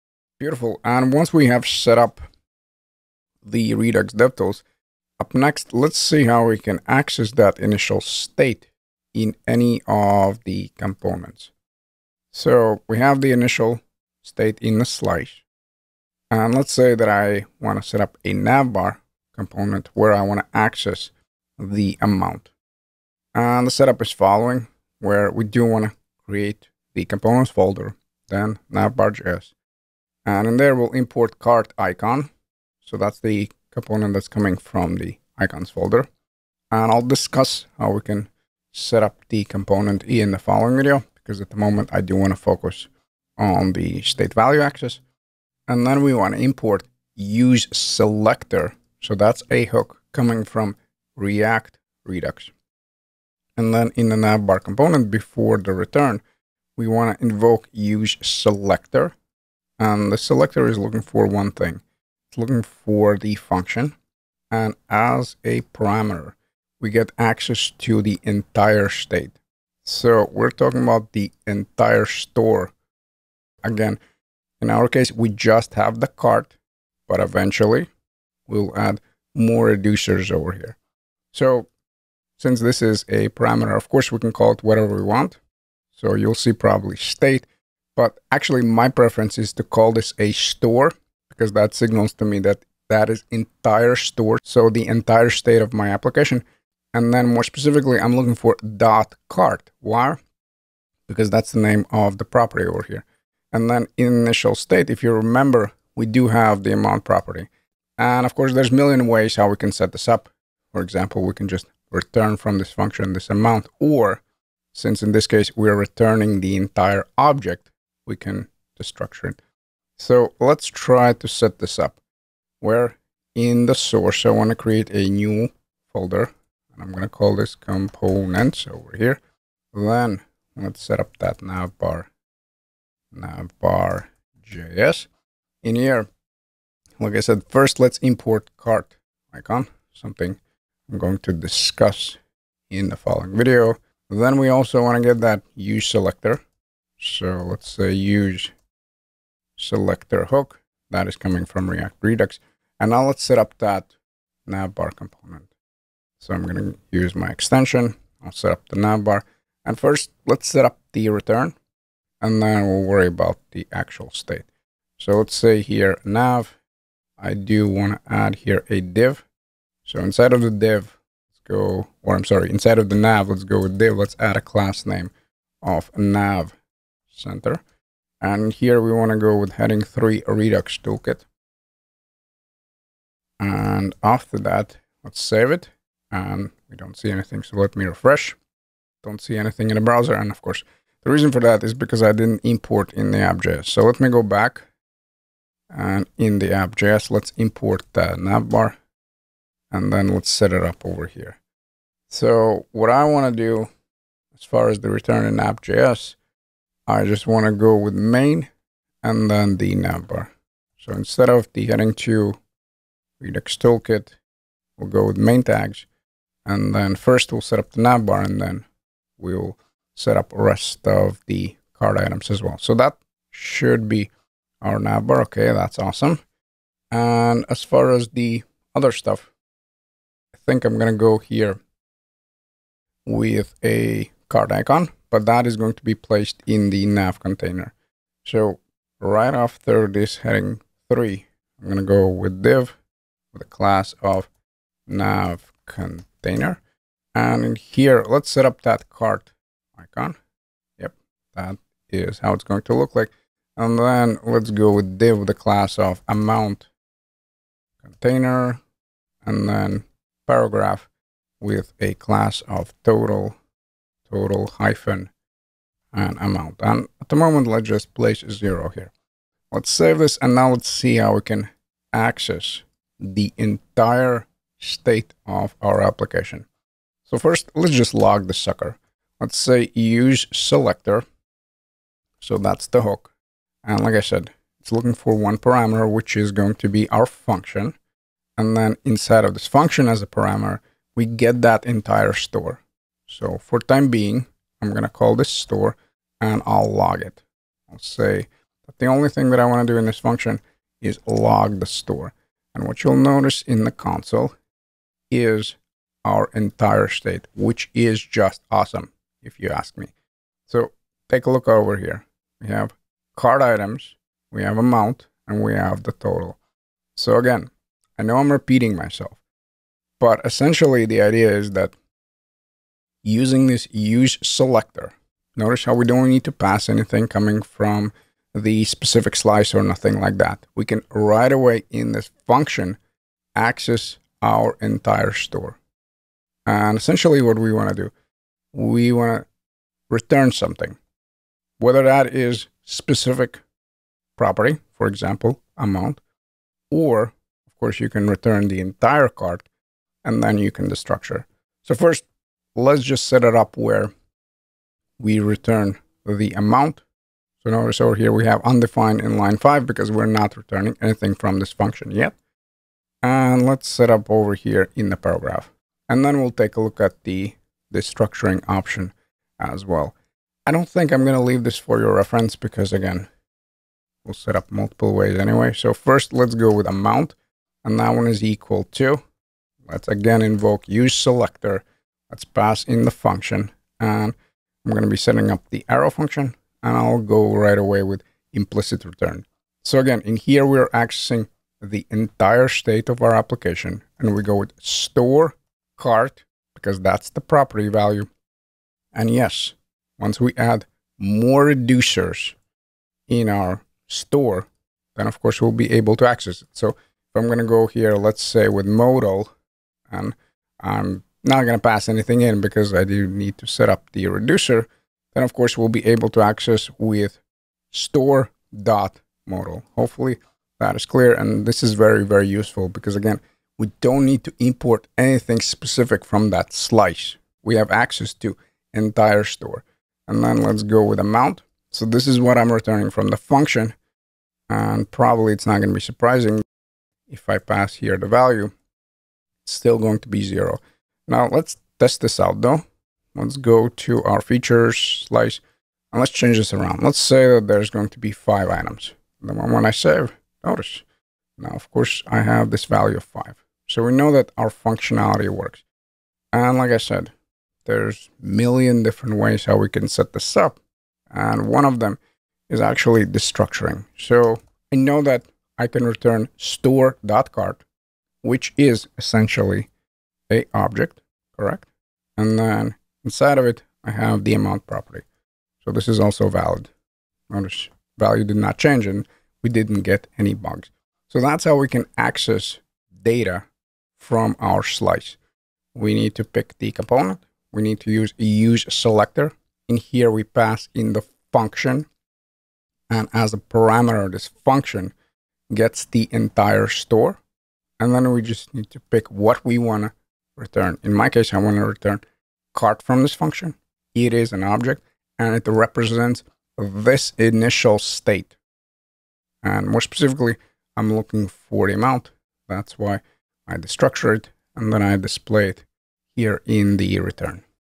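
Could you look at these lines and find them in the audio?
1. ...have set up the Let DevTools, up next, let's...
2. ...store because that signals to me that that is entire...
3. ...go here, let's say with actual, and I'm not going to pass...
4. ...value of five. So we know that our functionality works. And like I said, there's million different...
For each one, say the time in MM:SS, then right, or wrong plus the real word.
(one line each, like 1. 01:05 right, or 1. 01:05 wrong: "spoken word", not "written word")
1. 00:01 wrong: "Redux", not "Let"
2. 01:30 right
3. 06:47 wrong: "modal", not "actual"
4. 07:32 right.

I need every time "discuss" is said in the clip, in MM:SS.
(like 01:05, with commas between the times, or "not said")
00:37, 02:21.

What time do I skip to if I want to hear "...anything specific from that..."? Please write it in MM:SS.
07:04.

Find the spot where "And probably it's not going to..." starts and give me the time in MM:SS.
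07:14.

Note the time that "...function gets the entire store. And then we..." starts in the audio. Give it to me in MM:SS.
08:14.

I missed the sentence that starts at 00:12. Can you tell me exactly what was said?
So we have the initial state in the slice.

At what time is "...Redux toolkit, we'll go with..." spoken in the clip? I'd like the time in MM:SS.
03:33.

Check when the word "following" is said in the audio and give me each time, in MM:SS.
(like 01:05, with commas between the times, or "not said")
00:24, 00:40, 02:22.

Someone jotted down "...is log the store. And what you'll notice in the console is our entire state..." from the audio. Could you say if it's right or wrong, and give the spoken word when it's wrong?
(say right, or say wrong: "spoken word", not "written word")
right.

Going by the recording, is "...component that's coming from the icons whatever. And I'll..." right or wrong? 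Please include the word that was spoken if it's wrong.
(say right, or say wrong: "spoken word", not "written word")
wrong: "folder", not "whatever".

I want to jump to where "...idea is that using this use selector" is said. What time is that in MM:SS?
05:21.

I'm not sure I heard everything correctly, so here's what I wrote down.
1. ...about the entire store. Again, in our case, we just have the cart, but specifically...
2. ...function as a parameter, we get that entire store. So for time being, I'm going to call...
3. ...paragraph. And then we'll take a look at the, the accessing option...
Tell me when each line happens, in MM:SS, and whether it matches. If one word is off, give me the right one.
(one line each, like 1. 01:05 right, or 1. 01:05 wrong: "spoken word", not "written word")
1. 01:10 wrong: "eventually", not "specifically"
2. 04:49 right
3. 06:04 wrong: "structuring", not "accessing".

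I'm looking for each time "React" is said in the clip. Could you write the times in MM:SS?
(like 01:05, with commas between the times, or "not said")
00:51, 02:31.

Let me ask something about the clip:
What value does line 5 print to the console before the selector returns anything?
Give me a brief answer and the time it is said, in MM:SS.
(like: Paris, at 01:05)
undefined, at 05:58.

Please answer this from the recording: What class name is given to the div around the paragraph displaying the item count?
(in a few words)
amount container.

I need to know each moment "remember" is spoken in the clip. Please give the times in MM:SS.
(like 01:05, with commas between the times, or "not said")
01:45.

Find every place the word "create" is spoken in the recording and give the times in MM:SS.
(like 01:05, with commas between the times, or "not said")
00:26, 02:04.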